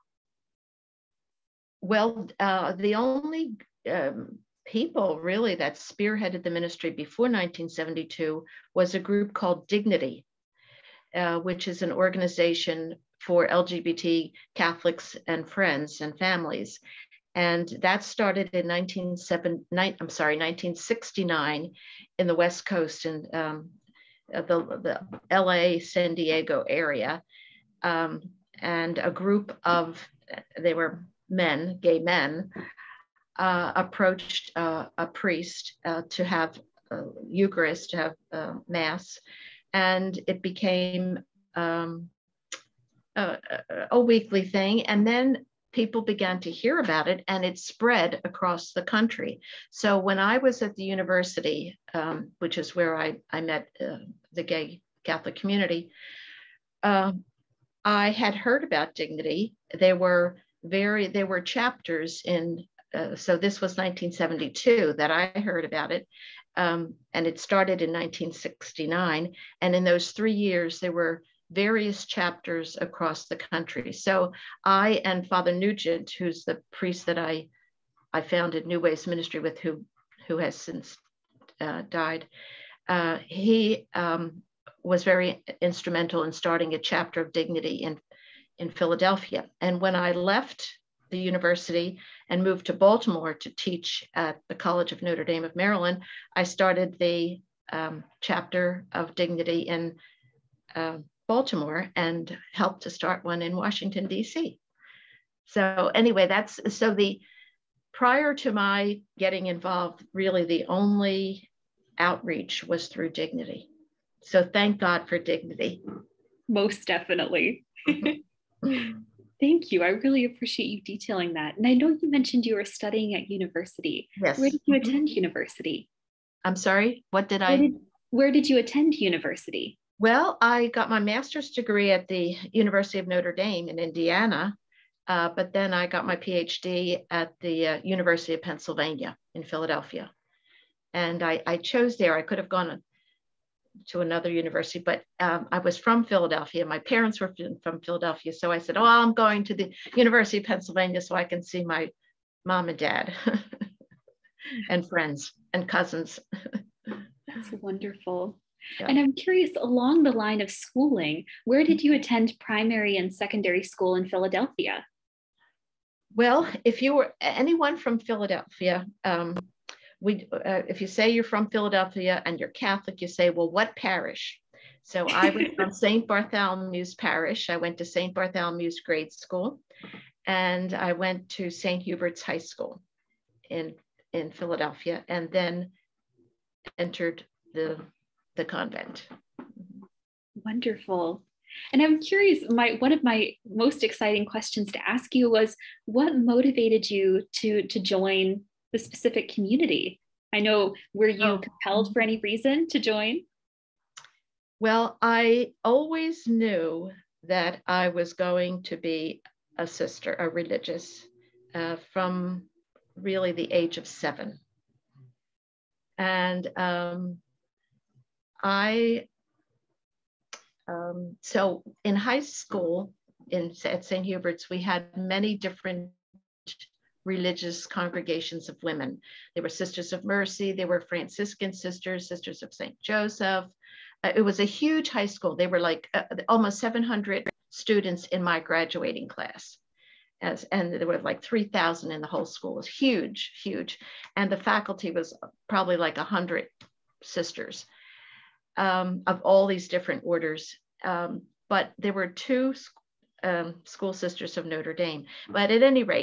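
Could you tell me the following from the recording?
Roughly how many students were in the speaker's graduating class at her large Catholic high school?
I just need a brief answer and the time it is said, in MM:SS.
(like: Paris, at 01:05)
700, at 03:56.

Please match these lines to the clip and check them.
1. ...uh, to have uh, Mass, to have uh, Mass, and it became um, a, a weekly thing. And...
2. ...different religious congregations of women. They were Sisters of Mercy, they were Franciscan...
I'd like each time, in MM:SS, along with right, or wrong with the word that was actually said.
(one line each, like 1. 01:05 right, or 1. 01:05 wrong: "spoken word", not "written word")
1. 00:35 wrong: "Eucharist", not "Mass"
2. 03:45 right.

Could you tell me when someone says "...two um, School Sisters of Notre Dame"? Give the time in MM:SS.
04:12.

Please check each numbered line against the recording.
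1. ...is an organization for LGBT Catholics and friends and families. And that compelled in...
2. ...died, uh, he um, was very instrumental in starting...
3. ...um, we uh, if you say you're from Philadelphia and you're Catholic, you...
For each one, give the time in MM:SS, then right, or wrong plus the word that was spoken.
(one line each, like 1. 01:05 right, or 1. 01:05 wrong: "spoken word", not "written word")
1. 00:11 wrong: "started", not "compelled"
2. 01:21 right
3. 02:49 right.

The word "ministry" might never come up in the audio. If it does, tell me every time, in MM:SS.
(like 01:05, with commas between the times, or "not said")
00:06, 01:19.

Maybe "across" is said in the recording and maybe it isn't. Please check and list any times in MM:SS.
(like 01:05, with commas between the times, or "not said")
00:48, 01:12.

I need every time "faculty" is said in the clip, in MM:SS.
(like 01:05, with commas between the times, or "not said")
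04:04.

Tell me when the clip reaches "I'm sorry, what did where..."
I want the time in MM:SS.
02:06.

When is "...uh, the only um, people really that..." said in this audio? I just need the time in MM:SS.
00:02.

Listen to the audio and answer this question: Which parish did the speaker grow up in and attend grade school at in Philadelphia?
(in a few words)
St. Bartholomew's.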